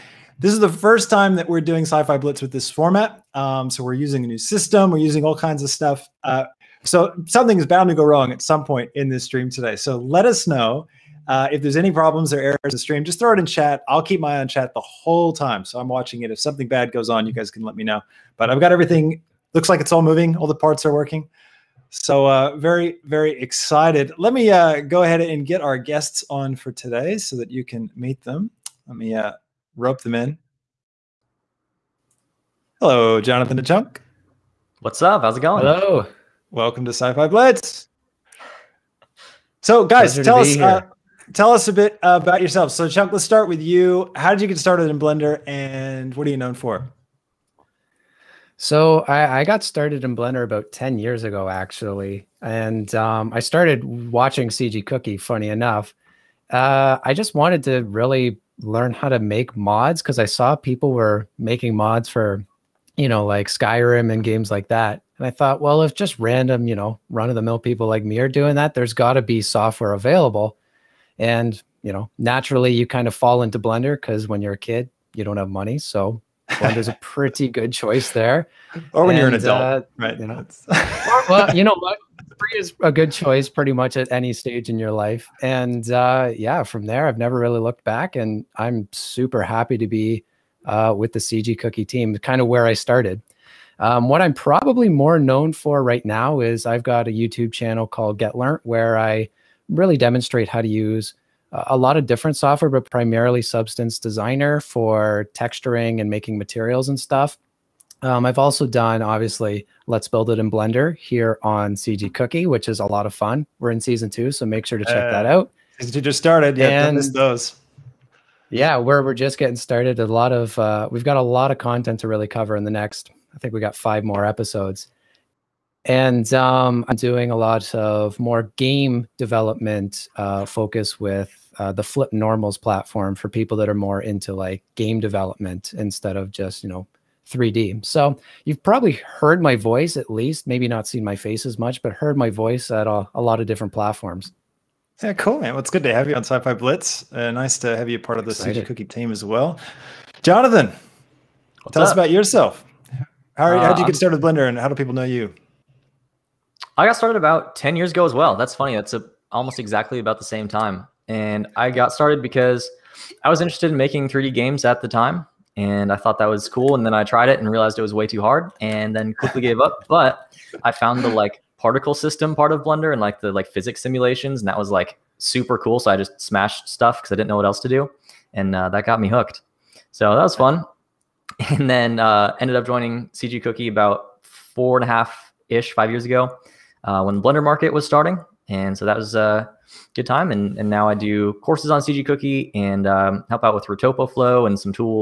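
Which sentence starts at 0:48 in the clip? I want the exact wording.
So I, I, got started in Blender about 10 years ago, actually.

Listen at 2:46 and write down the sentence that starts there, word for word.
And then I tried it and realized it was way too hard, and then quickly gave up.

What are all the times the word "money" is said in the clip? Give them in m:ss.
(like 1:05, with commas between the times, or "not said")
1:15.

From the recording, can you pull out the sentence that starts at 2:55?
So I just smashed stuff because I didn't know what else to do, and uh, that got me hooked.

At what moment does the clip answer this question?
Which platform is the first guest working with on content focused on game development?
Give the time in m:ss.
2:11.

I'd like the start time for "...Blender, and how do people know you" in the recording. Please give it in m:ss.
2:34.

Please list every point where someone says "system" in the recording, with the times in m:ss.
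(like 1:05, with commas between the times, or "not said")
0:04, 2:51.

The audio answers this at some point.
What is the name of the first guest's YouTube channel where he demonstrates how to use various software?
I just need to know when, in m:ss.
1:38.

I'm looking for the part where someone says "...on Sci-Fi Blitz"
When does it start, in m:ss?
2:26.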